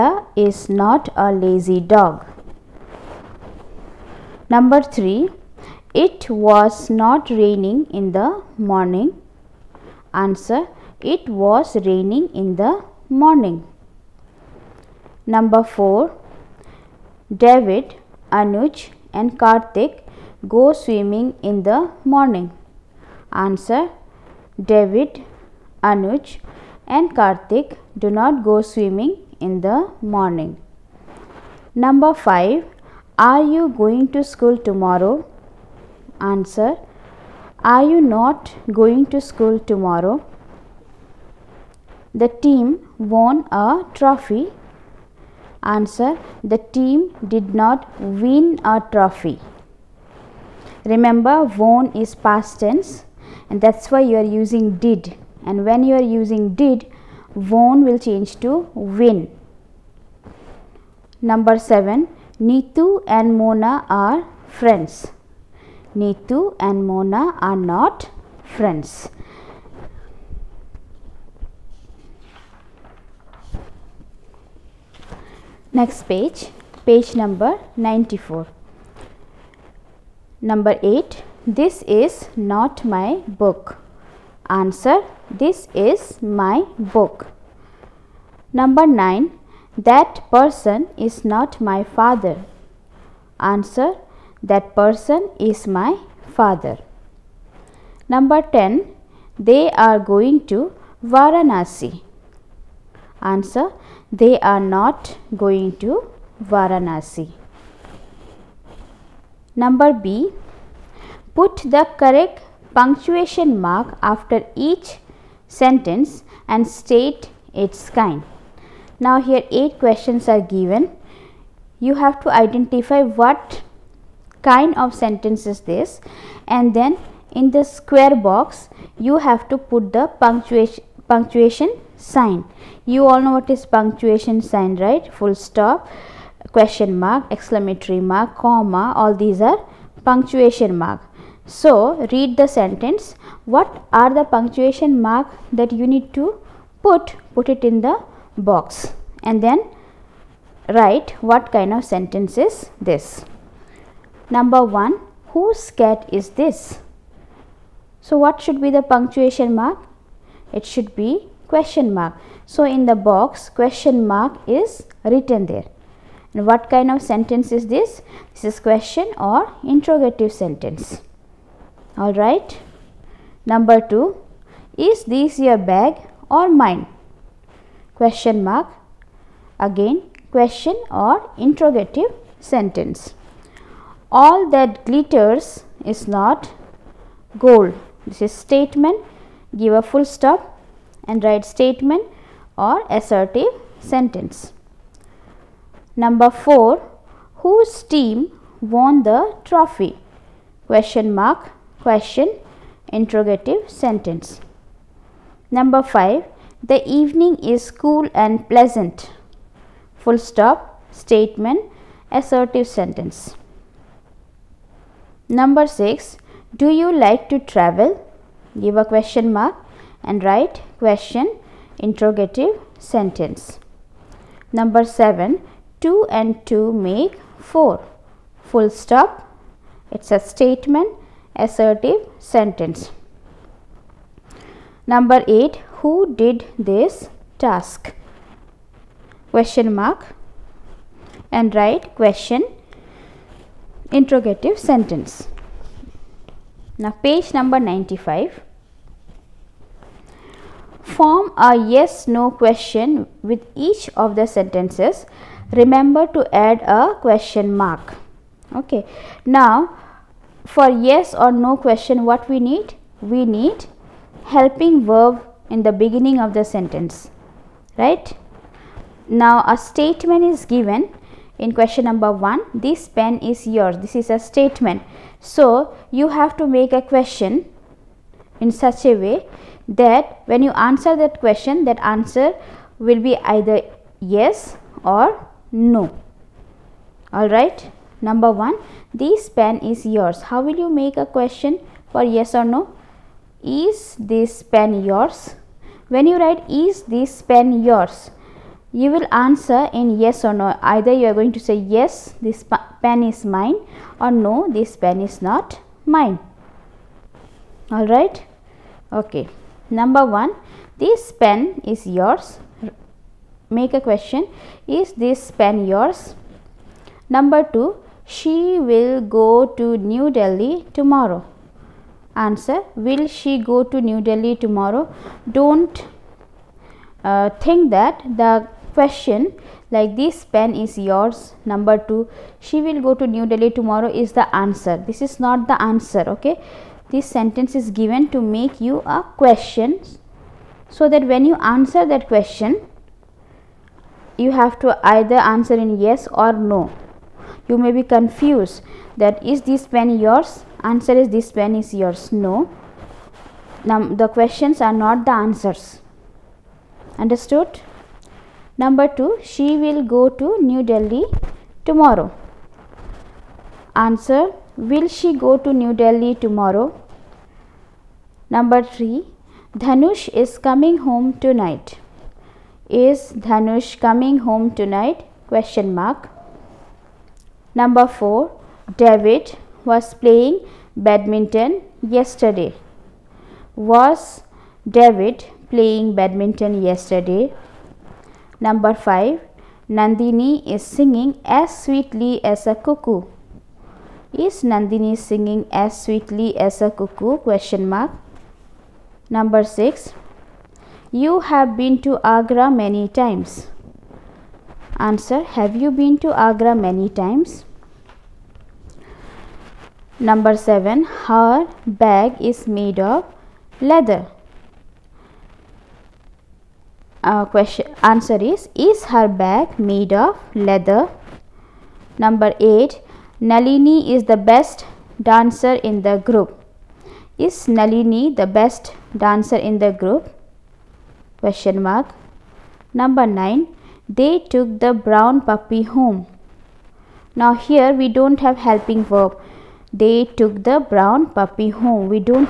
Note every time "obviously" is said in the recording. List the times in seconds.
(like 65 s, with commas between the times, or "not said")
not said.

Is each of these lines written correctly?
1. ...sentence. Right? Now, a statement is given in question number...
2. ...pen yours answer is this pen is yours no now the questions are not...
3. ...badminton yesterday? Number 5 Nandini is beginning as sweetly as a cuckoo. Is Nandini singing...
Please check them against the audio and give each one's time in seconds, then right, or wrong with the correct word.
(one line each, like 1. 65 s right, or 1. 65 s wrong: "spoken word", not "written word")
1. 266 s right
2. 349 s right
3. 385 s wrong: "singing", not "beginning".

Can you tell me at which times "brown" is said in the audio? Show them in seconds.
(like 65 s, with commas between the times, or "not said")
434 s, 440 s.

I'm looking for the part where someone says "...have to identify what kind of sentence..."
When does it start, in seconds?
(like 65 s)
121 s.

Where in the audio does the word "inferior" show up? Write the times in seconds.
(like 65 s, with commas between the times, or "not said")
not said.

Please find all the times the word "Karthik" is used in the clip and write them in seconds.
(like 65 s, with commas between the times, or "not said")
19 s, 27 s.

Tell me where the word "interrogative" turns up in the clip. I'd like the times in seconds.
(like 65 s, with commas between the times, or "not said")
169 s, 181 s, 202 s, 221 s, 243 s.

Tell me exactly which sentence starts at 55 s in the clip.
And when you are using did, won will change to win.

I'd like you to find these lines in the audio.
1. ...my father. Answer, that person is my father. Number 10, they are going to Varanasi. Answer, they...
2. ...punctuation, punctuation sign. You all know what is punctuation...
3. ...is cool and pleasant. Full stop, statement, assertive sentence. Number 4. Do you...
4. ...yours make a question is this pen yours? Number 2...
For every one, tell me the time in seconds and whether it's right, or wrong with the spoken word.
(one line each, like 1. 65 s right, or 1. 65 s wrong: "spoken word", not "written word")
1. 91 s right
2. 130 s right
3. 207 s wrong: "6", not "4"
4. 311 s right.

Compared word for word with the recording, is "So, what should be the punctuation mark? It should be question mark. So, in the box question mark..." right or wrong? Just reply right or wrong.
right.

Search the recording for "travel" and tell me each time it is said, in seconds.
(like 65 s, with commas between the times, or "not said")
217 s.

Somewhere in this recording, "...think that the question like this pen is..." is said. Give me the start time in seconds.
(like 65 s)
327 s.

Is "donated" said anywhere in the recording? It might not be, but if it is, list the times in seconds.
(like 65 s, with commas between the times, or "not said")
not said.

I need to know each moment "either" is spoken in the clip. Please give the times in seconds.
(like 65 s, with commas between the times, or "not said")
283 s, 300 s, 344 s.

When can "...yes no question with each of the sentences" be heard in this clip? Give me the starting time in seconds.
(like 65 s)
251 s.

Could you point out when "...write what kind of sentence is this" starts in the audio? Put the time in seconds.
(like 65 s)
150 s.